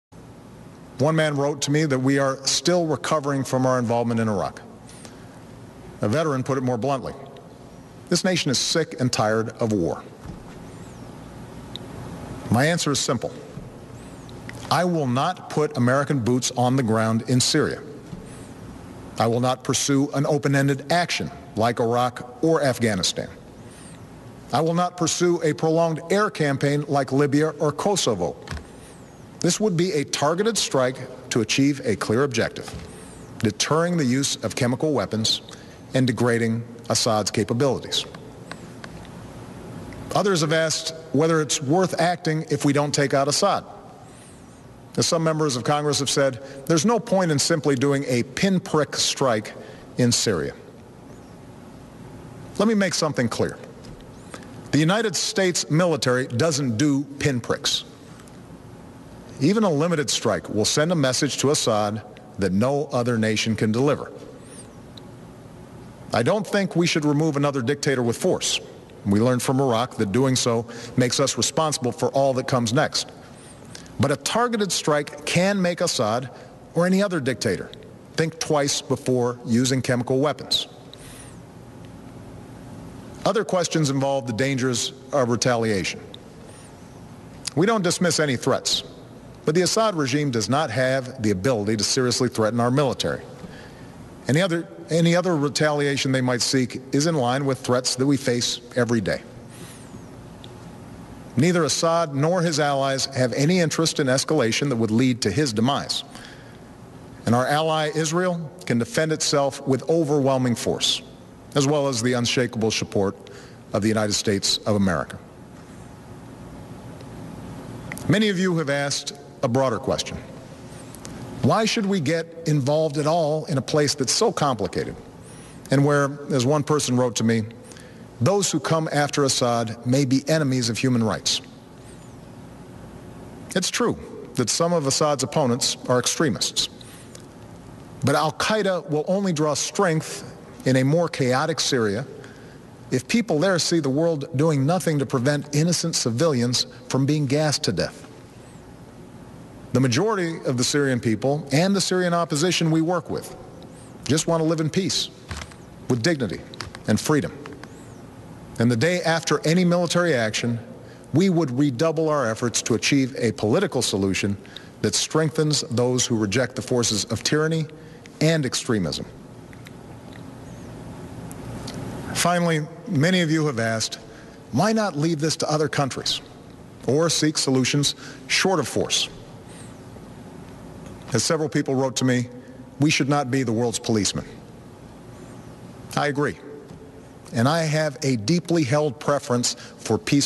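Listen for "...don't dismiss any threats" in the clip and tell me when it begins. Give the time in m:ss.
1:27.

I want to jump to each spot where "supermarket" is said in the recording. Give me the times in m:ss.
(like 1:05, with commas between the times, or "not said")
not said.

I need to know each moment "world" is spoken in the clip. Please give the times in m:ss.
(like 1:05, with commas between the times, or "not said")
2:23, 3:03.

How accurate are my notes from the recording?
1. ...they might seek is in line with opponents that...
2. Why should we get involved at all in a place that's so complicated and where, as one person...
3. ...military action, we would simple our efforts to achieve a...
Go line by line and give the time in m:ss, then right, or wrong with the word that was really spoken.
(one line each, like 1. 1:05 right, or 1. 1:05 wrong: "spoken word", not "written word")
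1. 1:36 wrong: "threats", not "opponents"
2. 2:01 right
3. 2:39 wrong: "redouble", not "simple".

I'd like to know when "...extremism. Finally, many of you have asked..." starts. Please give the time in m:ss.
2:48.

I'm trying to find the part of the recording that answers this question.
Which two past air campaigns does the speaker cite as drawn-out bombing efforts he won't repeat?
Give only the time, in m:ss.
0:27.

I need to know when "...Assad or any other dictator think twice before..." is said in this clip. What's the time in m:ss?
1:15.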